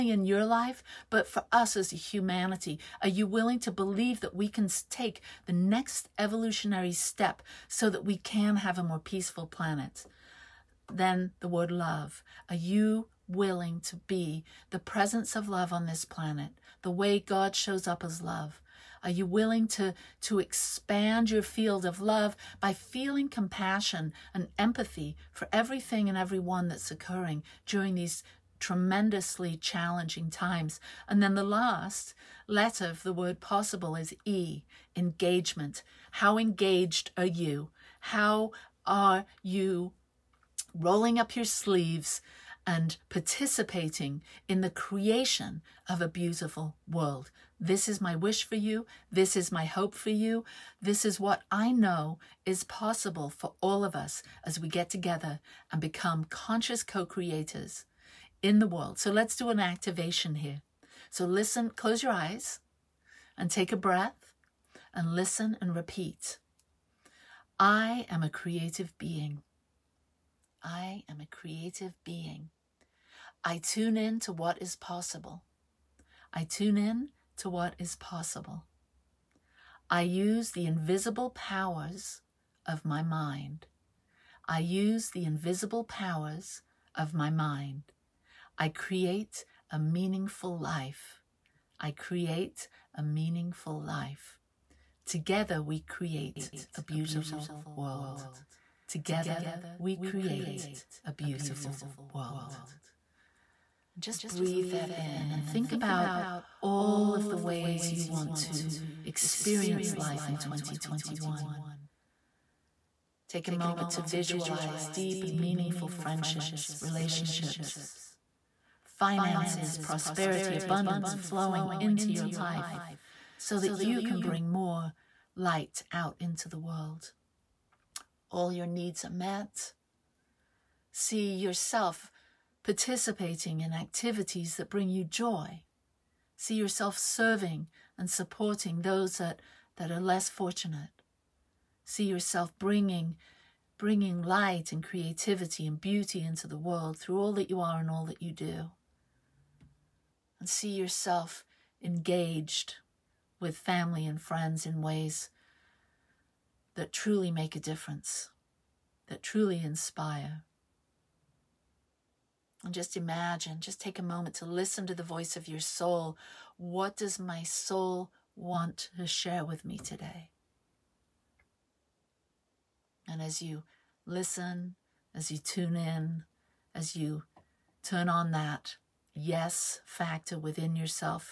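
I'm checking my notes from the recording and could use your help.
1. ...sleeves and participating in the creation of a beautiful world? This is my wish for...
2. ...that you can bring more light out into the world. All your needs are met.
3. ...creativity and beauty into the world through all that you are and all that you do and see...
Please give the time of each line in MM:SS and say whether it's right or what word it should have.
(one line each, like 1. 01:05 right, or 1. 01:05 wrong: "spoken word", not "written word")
1. 00:41 right
2. 02:03 right
3. 02:24 right.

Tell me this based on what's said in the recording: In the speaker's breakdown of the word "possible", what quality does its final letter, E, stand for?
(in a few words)
Engagement.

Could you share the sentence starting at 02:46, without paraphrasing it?
What does my soul want to share with me today?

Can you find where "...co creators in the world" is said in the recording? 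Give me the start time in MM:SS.
00:56.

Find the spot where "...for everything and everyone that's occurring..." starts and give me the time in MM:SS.
00:25.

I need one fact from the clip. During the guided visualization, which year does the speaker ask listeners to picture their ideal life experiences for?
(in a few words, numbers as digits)
2021.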